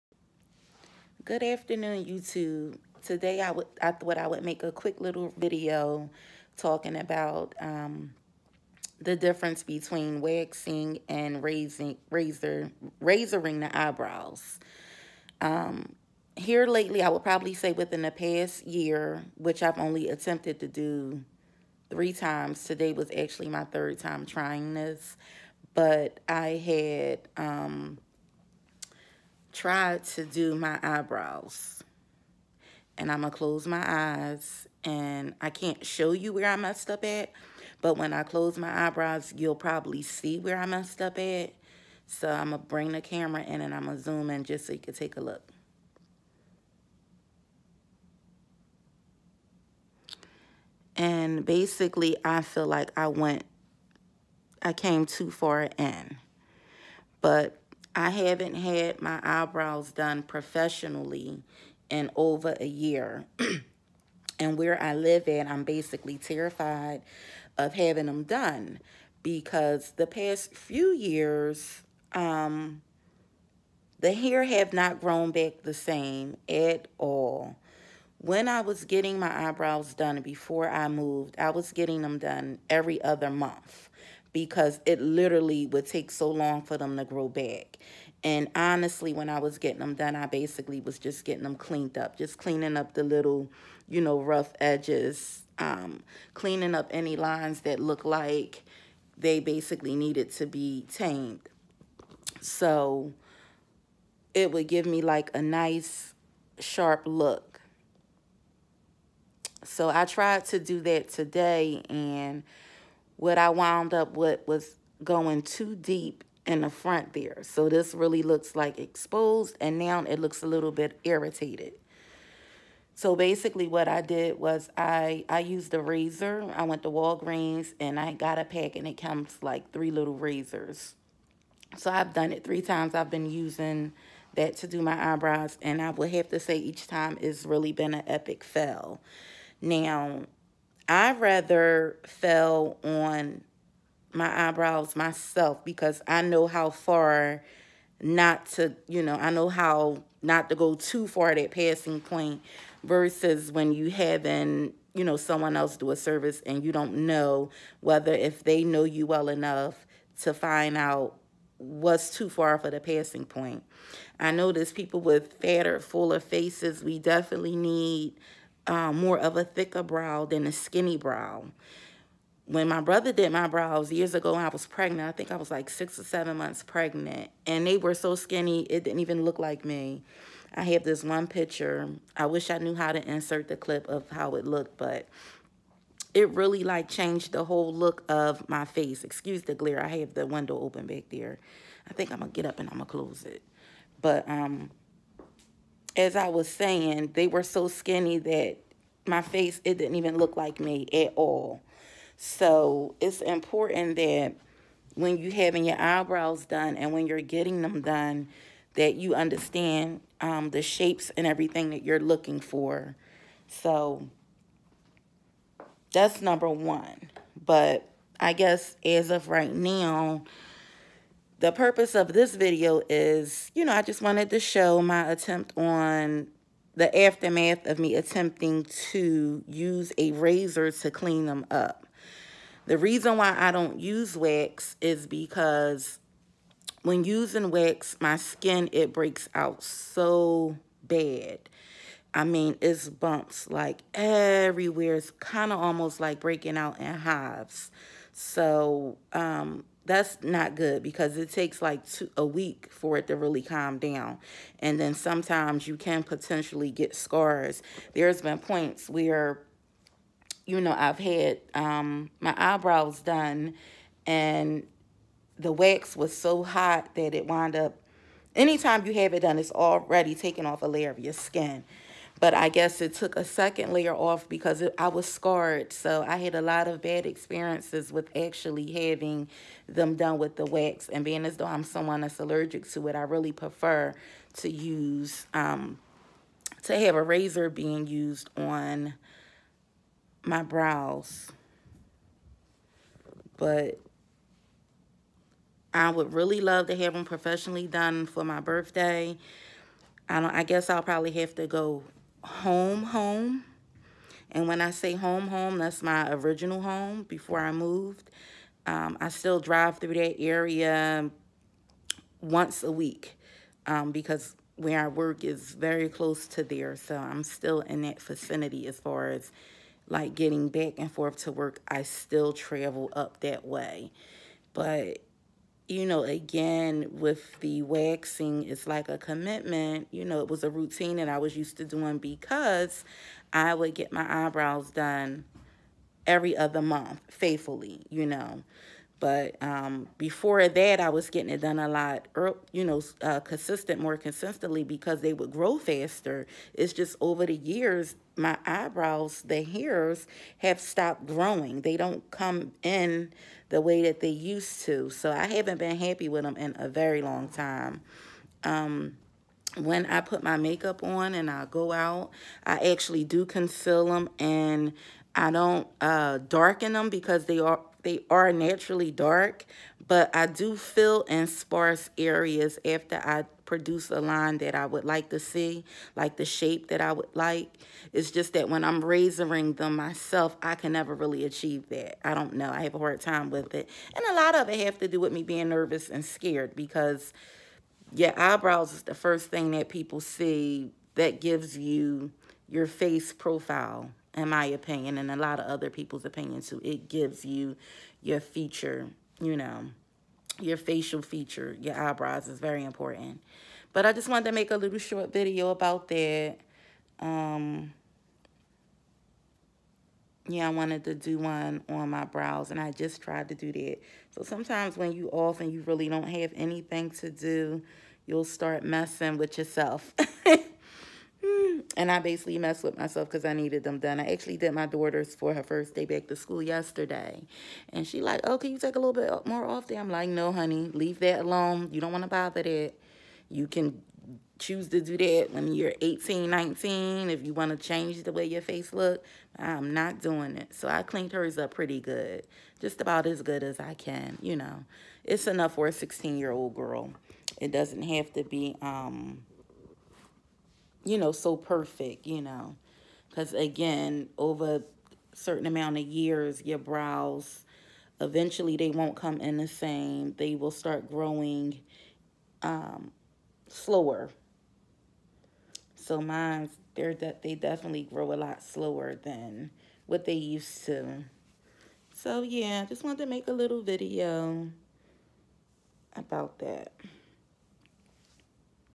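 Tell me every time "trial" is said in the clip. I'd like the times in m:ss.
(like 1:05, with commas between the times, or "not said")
not said.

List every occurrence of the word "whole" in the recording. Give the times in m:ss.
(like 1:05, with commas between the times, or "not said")
3:07.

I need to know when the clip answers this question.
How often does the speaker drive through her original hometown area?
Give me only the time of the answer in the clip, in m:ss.
5:12.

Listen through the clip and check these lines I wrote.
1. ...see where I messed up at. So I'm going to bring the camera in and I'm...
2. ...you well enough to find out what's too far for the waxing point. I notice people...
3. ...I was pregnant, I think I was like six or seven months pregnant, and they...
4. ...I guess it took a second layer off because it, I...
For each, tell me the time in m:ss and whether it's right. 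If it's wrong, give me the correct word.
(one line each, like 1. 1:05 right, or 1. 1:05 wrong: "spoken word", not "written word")
1. 0:40 right
2. 2:38 wrong: "passing", not "waxing"
3. 2:54 right
4. 4:32 right.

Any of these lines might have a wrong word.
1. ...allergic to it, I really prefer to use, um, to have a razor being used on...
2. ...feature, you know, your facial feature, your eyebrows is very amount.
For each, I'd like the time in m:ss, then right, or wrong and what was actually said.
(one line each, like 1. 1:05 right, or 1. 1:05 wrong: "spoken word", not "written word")
1. 4:42 right
2. 6:38 wrong: "important", not "amount".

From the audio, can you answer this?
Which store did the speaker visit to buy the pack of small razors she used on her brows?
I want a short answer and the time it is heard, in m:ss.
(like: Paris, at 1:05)
Walgreens, at 2:06.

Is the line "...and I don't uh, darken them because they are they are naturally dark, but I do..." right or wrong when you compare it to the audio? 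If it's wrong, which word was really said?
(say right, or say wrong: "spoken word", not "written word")
right.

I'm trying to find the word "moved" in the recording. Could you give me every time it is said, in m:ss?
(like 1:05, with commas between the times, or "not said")
1:20, 5:07.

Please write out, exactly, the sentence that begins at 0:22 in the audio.
Today was actually my third time trying this, but I had...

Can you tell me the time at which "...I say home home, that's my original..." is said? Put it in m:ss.
5:04.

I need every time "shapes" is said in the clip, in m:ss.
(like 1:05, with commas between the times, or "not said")
3:30, 6:16.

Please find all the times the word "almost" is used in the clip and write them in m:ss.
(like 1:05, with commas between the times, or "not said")
4:05.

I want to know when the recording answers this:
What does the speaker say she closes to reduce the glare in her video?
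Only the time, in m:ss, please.
3:10.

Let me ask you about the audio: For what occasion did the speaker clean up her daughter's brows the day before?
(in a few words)
First day back to school.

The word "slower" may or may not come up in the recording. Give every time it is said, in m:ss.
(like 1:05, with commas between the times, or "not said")
7:43, 7:48.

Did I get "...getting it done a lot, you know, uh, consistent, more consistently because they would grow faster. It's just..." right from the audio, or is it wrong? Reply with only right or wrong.
right.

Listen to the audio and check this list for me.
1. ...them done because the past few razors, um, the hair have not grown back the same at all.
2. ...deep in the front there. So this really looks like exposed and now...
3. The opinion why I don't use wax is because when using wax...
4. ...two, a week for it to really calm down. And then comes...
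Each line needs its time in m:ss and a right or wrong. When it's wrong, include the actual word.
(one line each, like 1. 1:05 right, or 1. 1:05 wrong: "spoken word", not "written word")
1. 1:08 wrong: "years", not "razors"
2. 1:55 right
3. 3:52 wrong: "reason", not "opinion"
4. 4:11 wrong: "sometimes", not "comes".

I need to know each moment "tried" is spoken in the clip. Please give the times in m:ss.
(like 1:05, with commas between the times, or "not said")
0:29, 1:50, 6:53.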